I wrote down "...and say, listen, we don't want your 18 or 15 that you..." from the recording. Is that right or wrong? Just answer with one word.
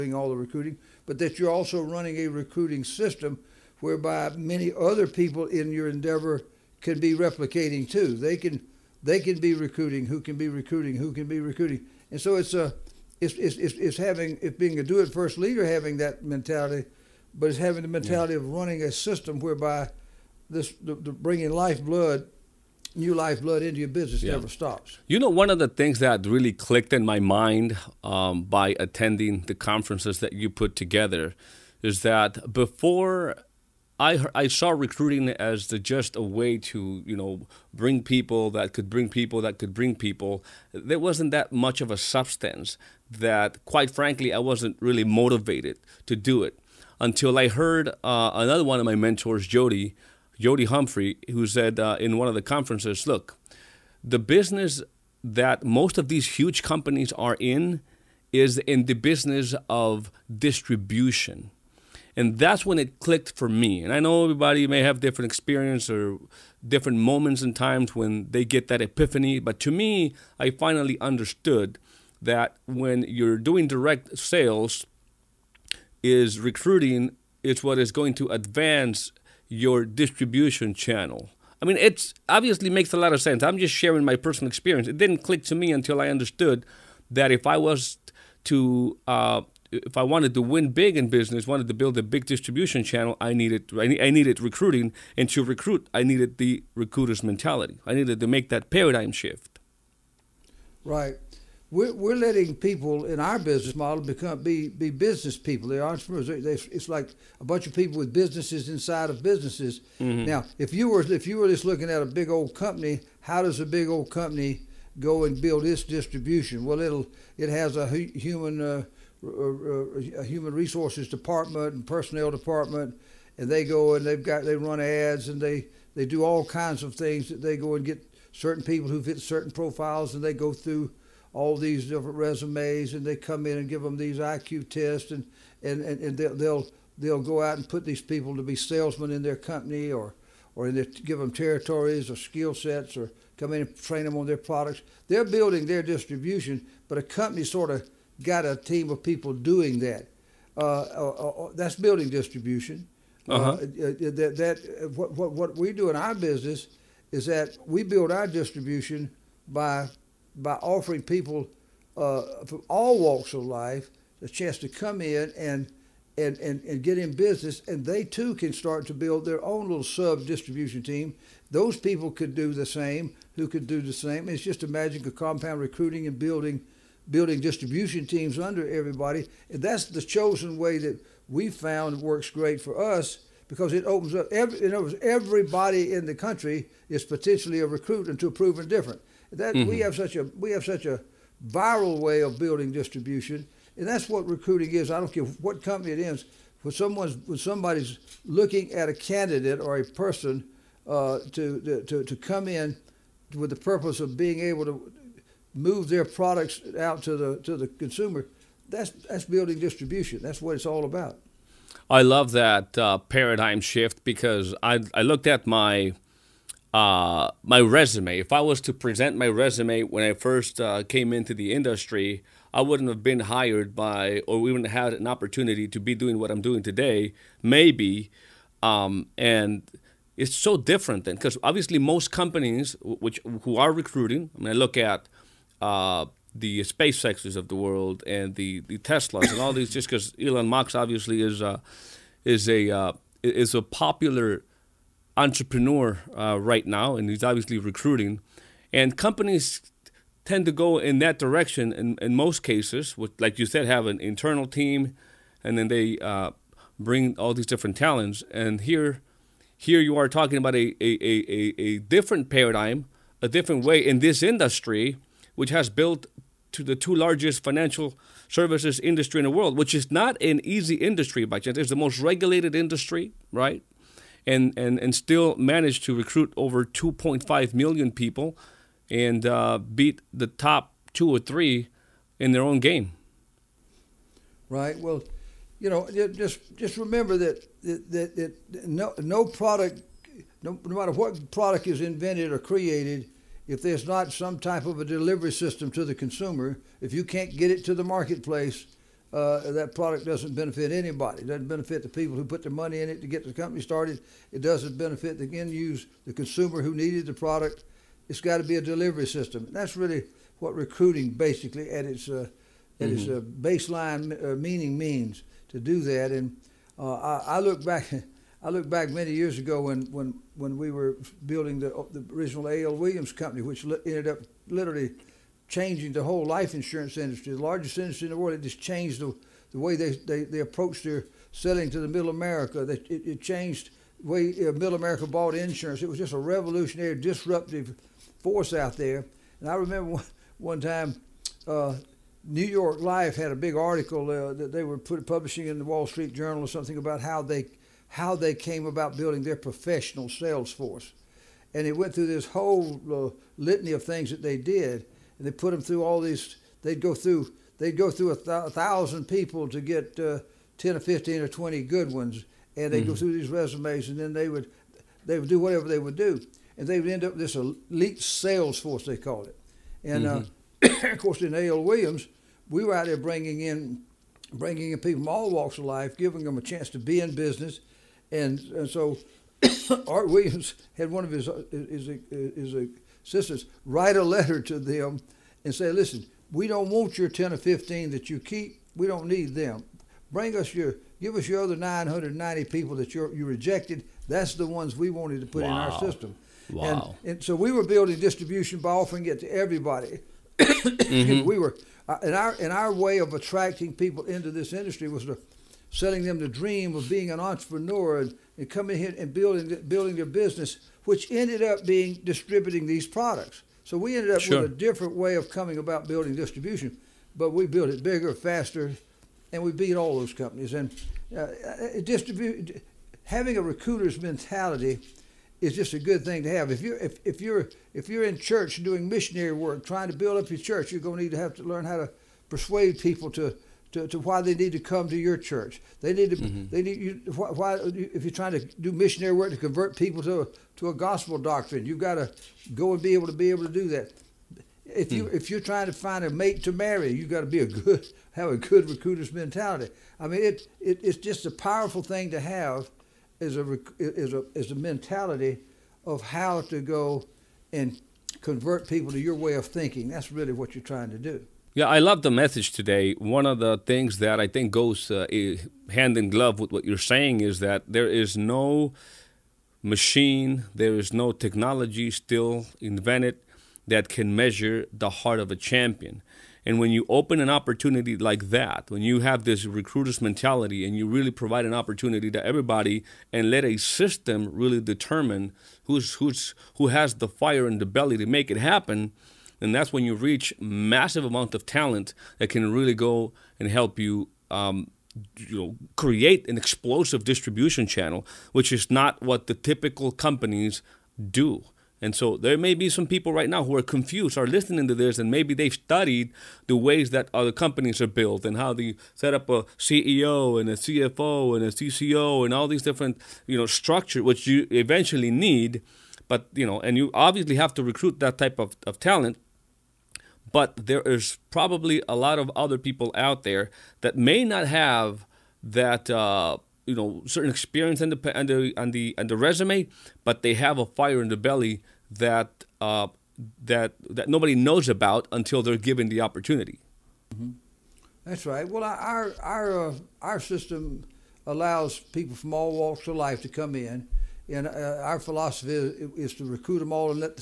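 wrong.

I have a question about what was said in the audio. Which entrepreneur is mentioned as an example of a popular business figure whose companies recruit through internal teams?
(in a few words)
Elon Musk.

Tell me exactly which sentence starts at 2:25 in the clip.
They're building their distribution, but a company sort of got a team of people doing that.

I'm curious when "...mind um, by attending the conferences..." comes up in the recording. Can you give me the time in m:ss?
0:27.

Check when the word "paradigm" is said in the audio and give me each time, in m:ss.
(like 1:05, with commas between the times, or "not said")
1:38, 3:32, 4:22.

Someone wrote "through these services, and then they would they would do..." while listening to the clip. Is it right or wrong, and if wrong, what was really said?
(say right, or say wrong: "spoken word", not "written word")
wrong: "resumes", not "services".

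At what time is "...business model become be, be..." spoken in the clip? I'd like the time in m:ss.
1:43.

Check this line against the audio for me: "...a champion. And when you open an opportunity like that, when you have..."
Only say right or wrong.
right.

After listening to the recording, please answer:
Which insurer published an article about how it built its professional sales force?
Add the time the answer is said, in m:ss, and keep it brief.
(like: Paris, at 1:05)
New York Life, at 5:42.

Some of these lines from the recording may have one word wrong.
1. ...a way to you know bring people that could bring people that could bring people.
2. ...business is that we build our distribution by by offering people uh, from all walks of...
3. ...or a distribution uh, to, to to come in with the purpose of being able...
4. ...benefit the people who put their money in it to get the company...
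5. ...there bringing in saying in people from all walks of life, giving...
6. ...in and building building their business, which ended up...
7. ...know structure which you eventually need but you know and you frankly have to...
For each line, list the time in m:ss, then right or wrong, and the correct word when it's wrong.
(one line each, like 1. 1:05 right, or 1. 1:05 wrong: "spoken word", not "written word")
1. 0:36 right
2. 2:36 right
3. 3:19 wrong: "person", not "distribution"
4. 5:01 right
5. 6:12 wrong: "bringing", not "saying"
6. 6:48 right
7. 8:33 wrong: "obviously", not "frankly".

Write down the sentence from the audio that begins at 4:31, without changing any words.
It's the most regulated industry, right?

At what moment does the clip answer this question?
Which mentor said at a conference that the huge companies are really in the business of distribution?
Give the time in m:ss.
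0:50.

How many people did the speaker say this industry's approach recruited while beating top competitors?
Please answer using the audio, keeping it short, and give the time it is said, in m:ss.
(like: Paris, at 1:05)
2.5 million, at 4:36.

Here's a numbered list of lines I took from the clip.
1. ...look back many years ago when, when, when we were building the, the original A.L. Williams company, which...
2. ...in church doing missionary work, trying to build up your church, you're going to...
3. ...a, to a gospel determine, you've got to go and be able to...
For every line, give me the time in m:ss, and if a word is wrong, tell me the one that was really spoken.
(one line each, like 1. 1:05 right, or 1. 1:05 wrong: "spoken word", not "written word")
1. 5:18 right
2. 7:08 right
3. 7:20 wrong: "doctrine", not "determine".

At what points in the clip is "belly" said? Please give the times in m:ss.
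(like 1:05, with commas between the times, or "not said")
8:07, 8:51.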